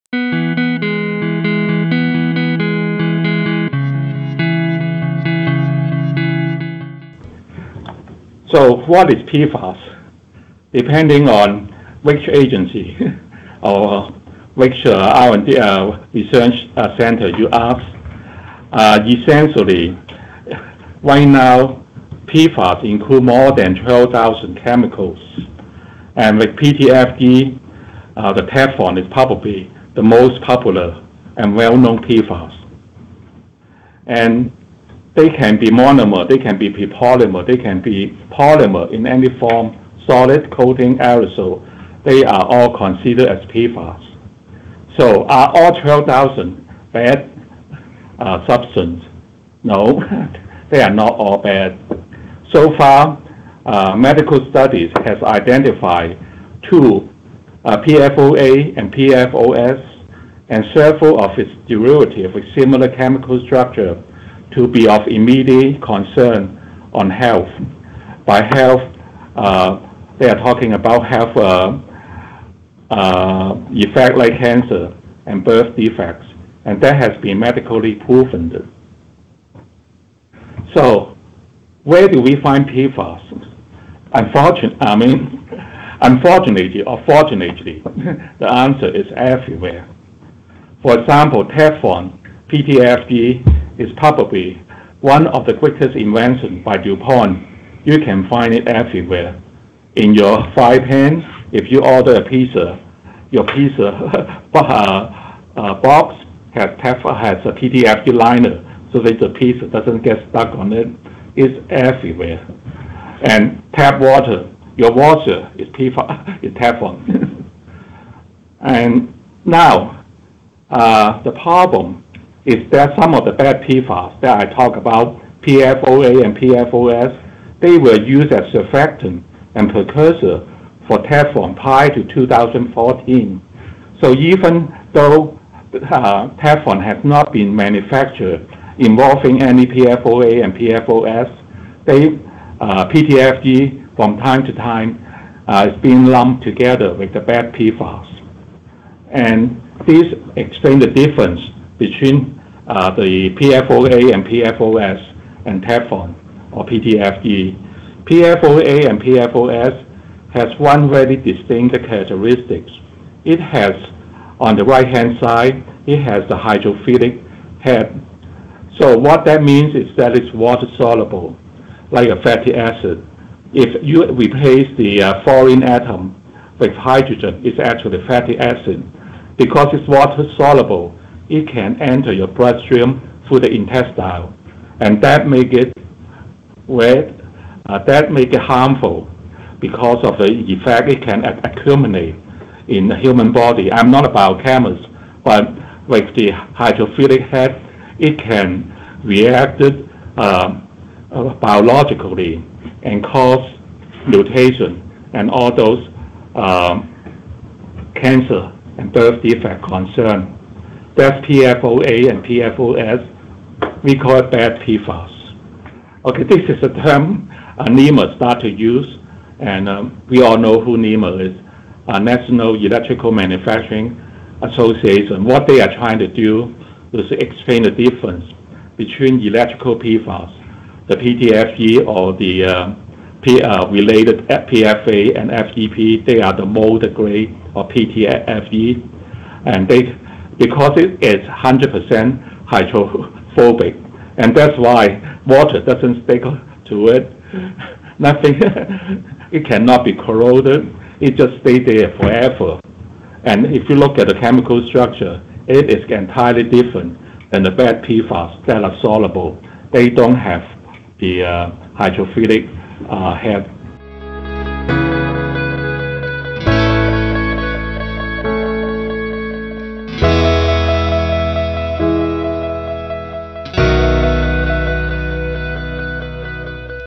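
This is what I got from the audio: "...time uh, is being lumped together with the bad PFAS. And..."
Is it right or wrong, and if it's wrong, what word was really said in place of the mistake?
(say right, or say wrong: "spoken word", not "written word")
right.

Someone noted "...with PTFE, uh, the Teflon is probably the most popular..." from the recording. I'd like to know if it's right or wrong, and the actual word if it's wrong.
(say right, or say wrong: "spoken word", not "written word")
right.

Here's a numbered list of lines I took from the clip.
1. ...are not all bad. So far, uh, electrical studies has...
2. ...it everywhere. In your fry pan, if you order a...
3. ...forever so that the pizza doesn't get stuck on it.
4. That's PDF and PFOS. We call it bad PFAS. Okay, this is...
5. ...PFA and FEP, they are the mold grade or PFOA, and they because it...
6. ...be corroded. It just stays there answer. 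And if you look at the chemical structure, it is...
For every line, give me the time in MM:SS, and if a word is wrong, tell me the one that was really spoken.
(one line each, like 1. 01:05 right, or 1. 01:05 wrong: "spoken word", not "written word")
1. 00:50 wrong: "medical", not "electrical"
2. 01:38 right
3. 01:48 wrong: "liner", not "forever"
4. 03:30 wrong: "PFOA", not "PDF"
5. 03:54 wrong: "PTFE", not "PFOA"
6. 04:09 wrong: "forever", not "answer".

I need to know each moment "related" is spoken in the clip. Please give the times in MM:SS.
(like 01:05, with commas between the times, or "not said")
03:53.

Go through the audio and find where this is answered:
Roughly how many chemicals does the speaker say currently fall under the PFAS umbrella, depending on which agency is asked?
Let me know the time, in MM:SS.
00:23.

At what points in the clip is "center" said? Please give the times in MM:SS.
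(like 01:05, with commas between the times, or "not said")
00:16.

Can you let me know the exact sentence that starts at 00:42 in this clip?
They are all considered as PFAS.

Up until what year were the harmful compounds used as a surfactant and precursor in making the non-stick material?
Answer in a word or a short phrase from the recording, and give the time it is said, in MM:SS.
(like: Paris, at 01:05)
2014, at 02:12.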